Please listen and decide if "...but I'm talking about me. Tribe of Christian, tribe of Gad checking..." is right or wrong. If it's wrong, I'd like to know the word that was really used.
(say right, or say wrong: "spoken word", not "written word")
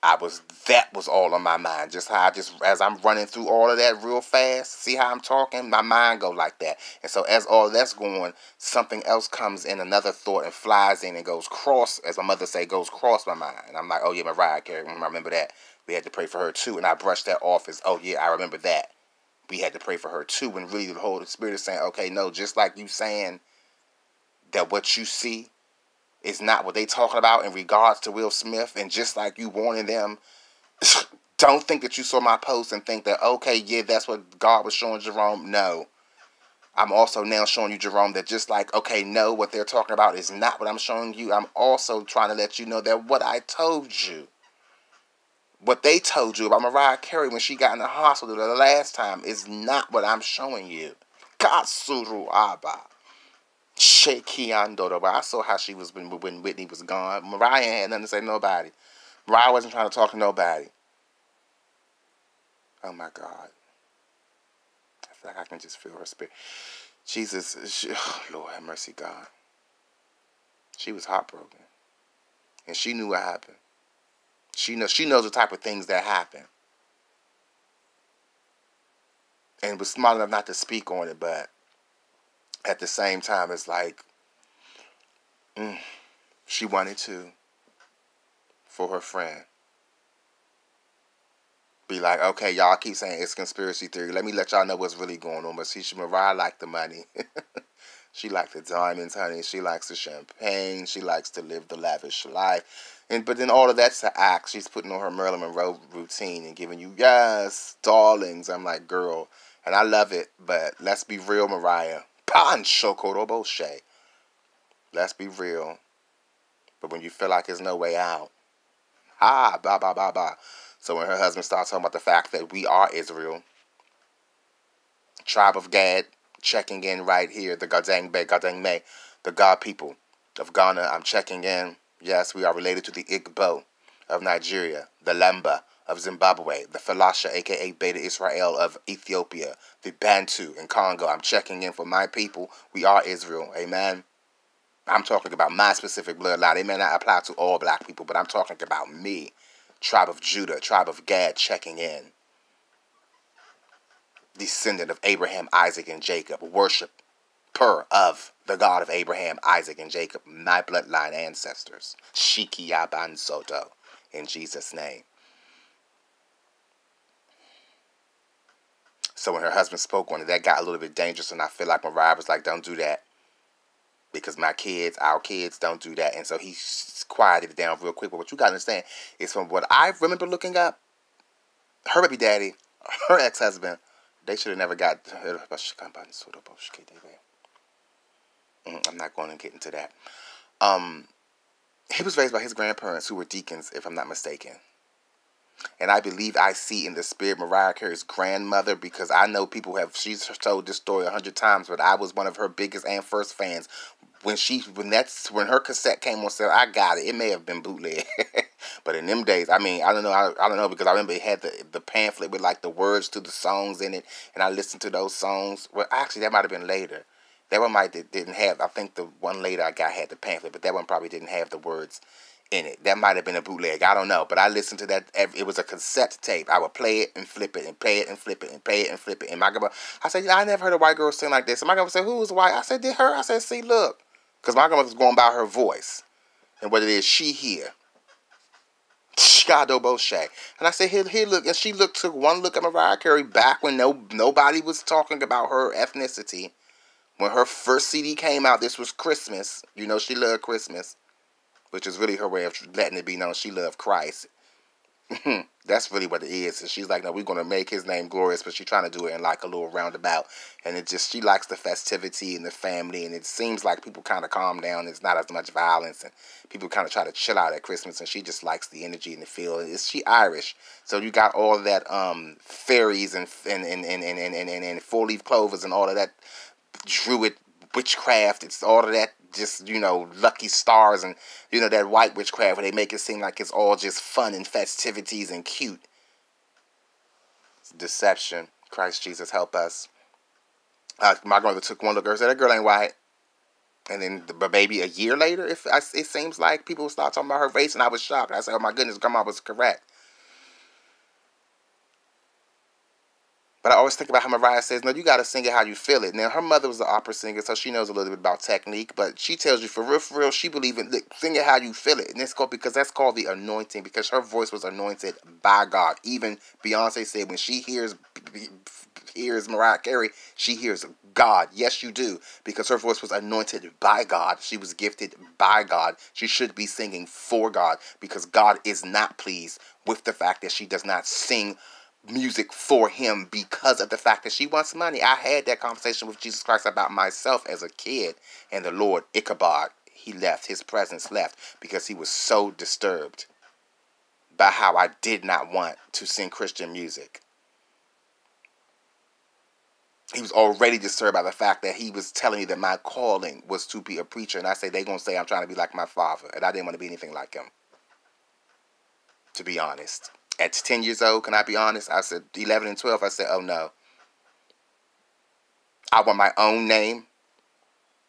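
wrong: "Judah", not "Christian".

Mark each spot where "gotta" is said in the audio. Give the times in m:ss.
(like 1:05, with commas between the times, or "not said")
2:58.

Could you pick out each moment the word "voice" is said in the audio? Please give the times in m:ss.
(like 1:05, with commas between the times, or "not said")
3:55, 5:14, 5:22.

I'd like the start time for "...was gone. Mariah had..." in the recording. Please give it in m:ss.
0:56.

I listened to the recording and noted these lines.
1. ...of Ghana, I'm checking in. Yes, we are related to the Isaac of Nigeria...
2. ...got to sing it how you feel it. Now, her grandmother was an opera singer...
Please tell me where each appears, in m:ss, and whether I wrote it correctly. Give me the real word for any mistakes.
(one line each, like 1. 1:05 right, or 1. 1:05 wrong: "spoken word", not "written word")
1. 2:10 wrong: "Igbo", not "Isaac"
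2. 5:05 wrong: "mother", not "grandmother".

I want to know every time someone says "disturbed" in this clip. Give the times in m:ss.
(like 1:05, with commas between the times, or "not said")
5:42, 5:50.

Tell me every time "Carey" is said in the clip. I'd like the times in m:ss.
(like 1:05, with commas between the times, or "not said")
0:14, 0:46, 3:17, 4:02, 5:19.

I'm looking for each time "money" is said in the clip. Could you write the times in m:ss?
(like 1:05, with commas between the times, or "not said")
1:36, 5:34.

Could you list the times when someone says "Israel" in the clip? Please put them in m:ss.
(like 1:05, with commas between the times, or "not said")
2:02, 2:17, 2:23.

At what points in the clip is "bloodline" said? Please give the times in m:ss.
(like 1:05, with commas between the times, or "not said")
2:26, 2:40.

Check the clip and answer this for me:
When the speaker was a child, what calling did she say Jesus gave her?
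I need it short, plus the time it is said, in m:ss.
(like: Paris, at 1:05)
Preacher, at 5:54.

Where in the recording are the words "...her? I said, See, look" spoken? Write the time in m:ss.
3:52.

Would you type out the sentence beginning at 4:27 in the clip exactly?
And she just likes the energy and the feel.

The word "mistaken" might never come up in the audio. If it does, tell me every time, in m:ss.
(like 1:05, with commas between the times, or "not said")
3:14.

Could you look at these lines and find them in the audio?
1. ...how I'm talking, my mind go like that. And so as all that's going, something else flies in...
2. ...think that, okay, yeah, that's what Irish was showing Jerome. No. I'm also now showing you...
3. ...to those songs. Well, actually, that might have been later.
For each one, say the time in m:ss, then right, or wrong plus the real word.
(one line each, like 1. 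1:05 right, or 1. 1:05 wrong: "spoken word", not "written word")
1. 0:04 wrong: "comes", not "flies"
2. 0:32 wrong: "God", not "Irish"
3. 3:34 right.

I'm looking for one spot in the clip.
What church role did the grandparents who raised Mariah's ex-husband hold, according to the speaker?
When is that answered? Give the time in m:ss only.
3:13.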